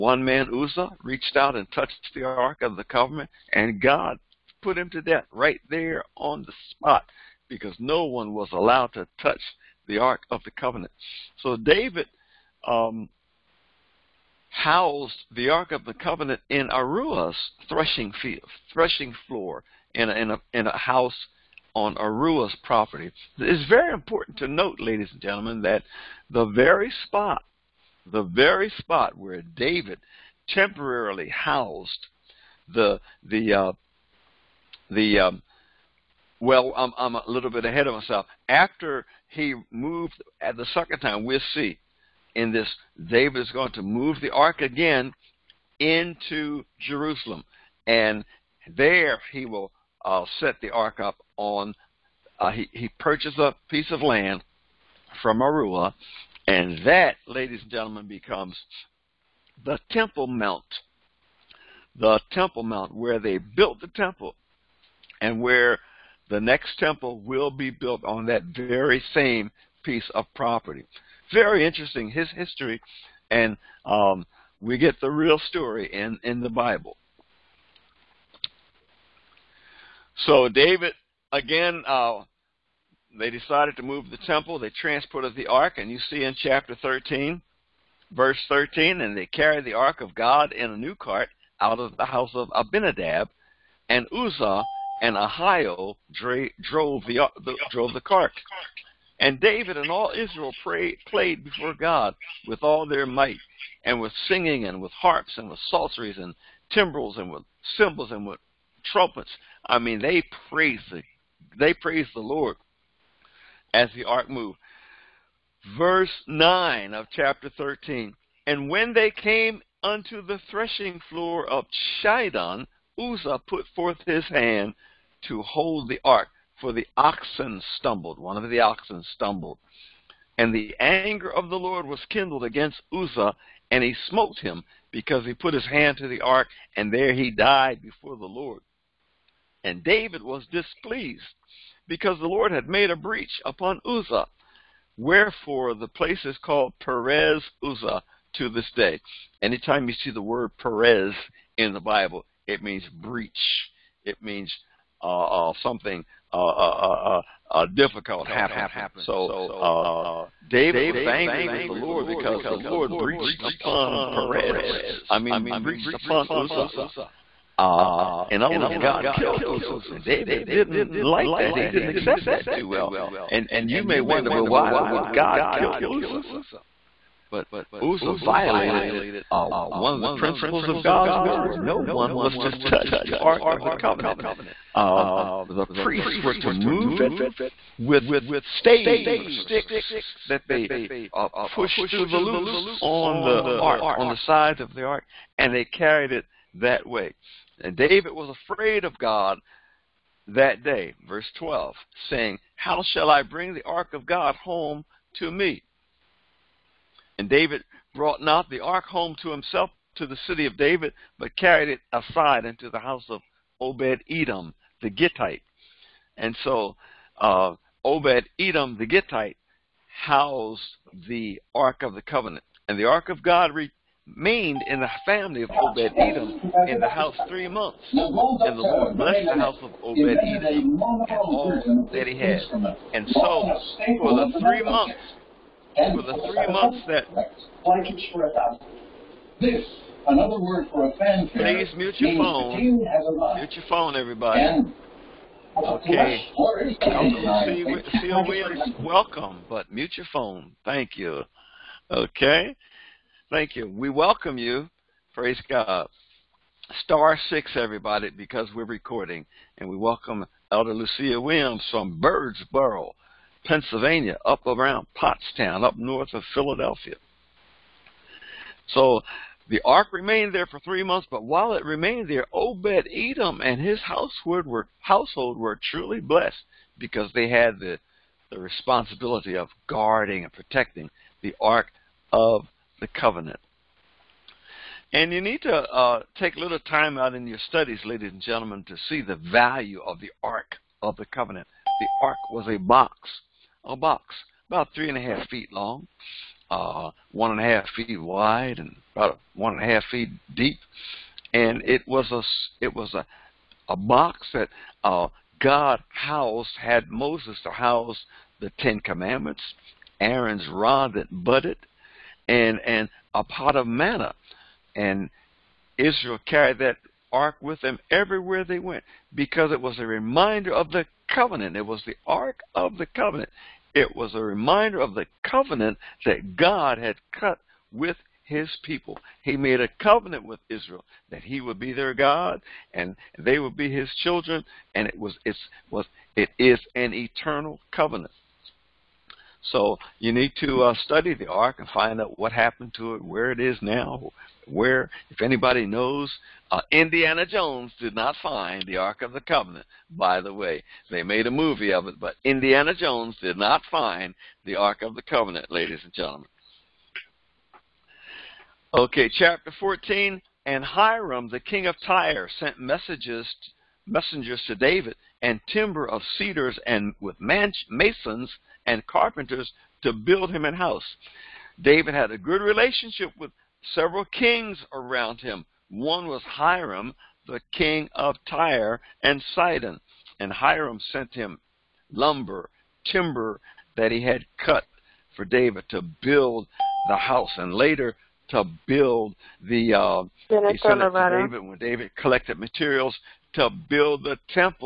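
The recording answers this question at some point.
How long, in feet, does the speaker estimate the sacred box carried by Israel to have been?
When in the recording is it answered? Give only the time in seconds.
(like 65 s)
294 s.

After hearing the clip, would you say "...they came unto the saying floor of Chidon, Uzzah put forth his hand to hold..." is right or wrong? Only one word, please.
wrong.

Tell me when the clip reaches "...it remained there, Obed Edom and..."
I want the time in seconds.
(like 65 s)
271 s.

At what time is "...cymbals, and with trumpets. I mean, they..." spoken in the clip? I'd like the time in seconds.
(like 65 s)
107 s.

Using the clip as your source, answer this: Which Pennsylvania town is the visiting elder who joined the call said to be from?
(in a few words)
Birdsboro.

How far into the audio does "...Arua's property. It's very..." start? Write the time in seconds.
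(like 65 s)
21 s.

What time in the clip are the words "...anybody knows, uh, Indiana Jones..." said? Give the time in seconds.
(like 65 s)
345 s.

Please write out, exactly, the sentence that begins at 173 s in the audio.
And and you may wonder, well, why would God kill Uzzah?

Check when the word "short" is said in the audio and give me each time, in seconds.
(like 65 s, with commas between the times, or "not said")
not said.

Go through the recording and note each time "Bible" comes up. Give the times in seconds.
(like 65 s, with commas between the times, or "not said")
76 s, 151 s.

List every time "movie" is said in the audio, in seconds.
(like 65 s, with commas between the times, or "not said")
351 s.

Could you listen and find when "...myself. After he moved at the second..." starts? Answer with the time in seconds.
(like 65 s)
37 s.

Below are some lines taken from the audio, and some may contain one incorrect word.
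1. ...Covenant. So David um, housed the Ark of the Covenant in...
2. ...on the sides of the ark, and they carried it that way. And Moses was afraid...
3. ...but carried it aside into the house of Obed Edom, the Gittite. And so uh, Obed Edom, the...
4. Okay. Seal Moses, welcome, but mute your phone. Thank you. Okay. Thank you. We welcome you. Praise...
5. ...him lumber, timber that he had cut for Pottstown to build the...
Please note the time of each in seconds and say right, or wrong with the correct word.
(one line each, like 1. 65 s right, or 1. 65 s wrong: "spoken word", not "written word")
1. 10 s right
2. 193 s wrong: "David", not "Moses"
3. 211 s right
4. 245 s wrong: "Williams", not "Moses"
5. 381 s wrong: "David", not "Pottstown".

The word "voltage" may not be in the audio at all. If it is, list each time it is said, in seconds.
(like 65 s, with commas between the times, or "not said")
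not said.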